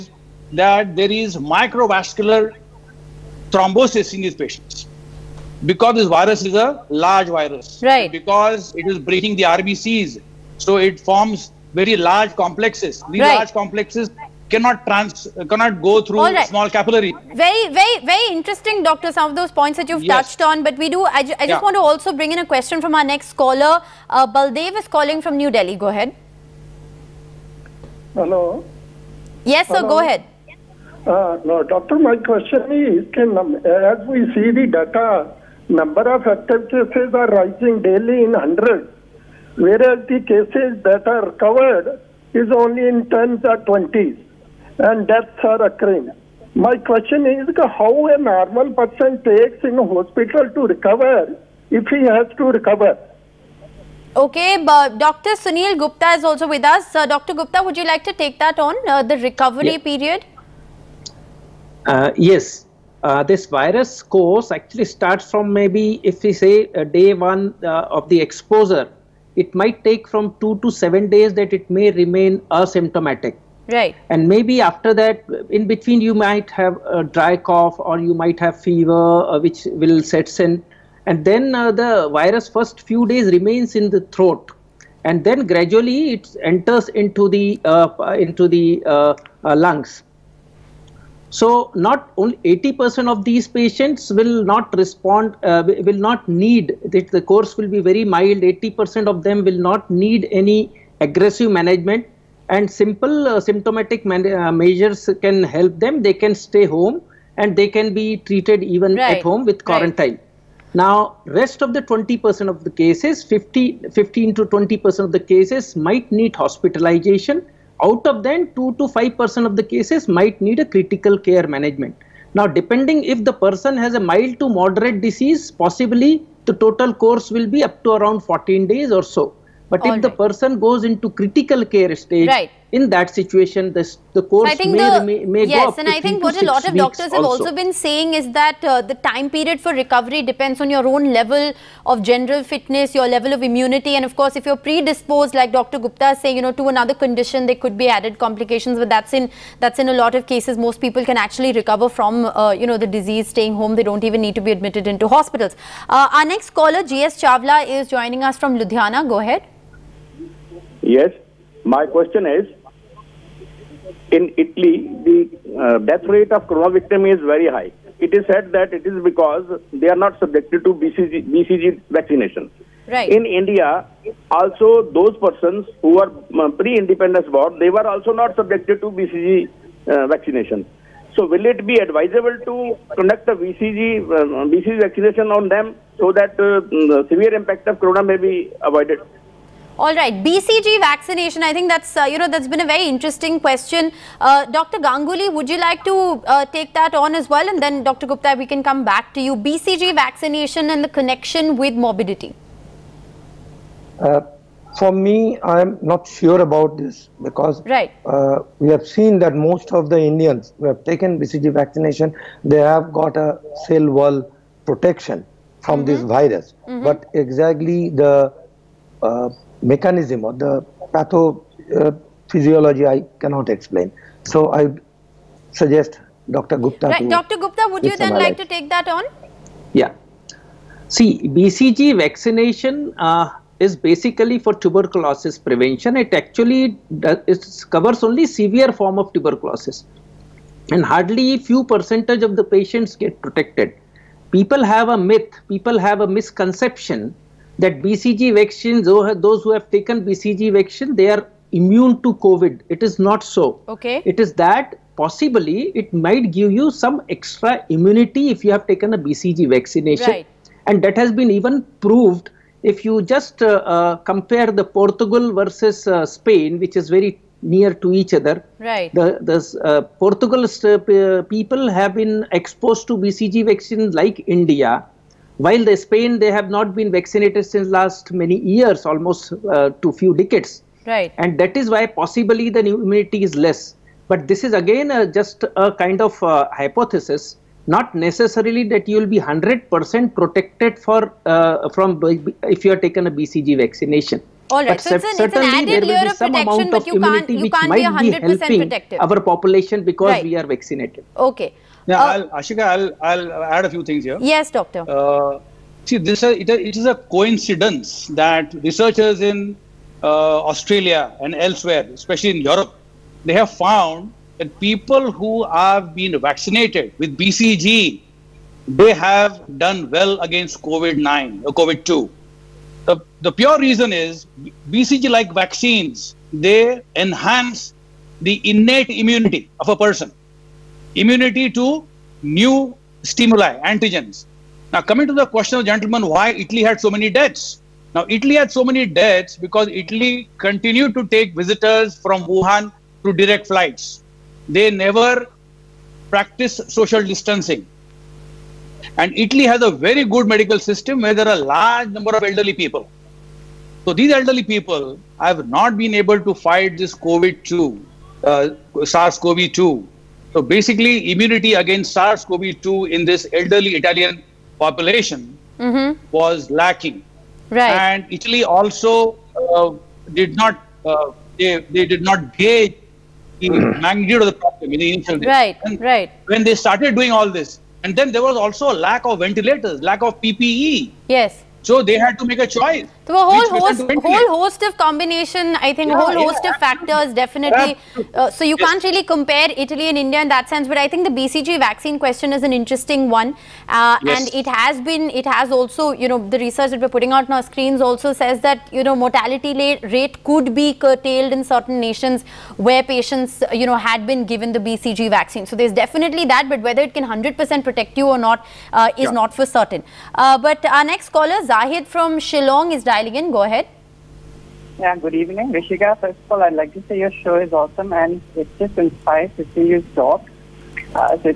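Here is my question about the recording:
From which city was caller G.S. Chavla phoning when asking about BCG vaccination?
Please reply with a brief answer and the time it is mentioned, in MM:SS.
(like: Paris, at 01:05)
Ludhiana, at 02:38.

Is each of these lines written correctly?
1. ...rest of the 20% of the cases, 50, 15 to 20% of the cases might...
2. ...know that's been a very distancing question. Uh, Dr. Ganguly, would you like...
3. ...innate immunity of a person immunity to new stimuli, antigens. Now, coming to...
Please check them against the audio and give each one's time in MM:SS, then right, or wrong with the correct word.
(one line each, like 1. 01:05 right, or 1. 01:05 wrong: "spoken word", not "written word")
1. 01:51 right
2. 03:12 wrong: "interesting", not "distancing"
3. 05:28 right.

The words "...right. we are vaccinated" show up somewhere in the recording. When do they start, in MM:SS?
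05:00.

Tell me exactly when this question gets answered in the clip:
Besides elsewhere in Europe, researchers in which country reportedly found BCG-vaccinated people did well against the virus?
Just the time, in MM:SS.
05:10.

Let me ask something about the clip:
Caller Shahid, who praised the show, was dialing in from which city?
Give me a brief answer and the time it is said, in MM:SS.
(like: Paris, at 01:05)
Shillong, at 06:52.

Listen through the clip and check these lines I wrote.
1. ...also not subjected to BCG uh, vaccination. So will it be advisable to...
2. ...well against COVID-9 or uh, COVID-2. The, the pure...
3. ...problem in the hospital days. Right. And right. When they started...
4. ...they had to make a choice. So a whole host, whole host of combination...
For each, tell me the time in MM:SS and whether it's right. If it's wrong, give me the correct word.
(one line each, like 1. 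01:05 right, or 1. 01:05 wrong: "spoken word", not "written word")
1. 02:57 right
2. 05:19 right
3. 06:14 wrong: "initial", not "hospital"
4. 06:21 right.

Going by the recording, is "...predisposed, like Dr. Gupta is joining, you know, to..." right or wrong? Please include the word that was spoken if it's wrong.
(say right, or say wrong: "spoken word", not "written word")
wrong: "saying", not "joining".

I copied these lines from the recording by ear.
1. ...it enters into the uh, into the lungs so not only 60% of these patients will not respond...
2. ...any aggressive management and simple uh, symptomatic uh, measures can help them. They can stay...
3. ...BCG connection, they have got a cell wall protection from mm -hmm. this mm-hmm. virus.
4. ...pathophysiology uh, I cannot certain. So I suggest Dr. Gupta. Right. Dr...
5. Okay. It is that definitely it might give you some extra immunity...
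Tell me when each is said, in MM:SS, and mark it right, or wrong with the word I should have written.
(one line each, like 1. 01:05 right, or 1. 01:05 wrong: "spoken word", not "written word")
1. 01:26 wrong: "80", not "60"
2. 01:40 right
3. 03:31 wrong: "vaccination", not "connection"
4. 03:40 wrong: "explain", not "certain"
5. 04:13 wrong: "possibly", not "definitely".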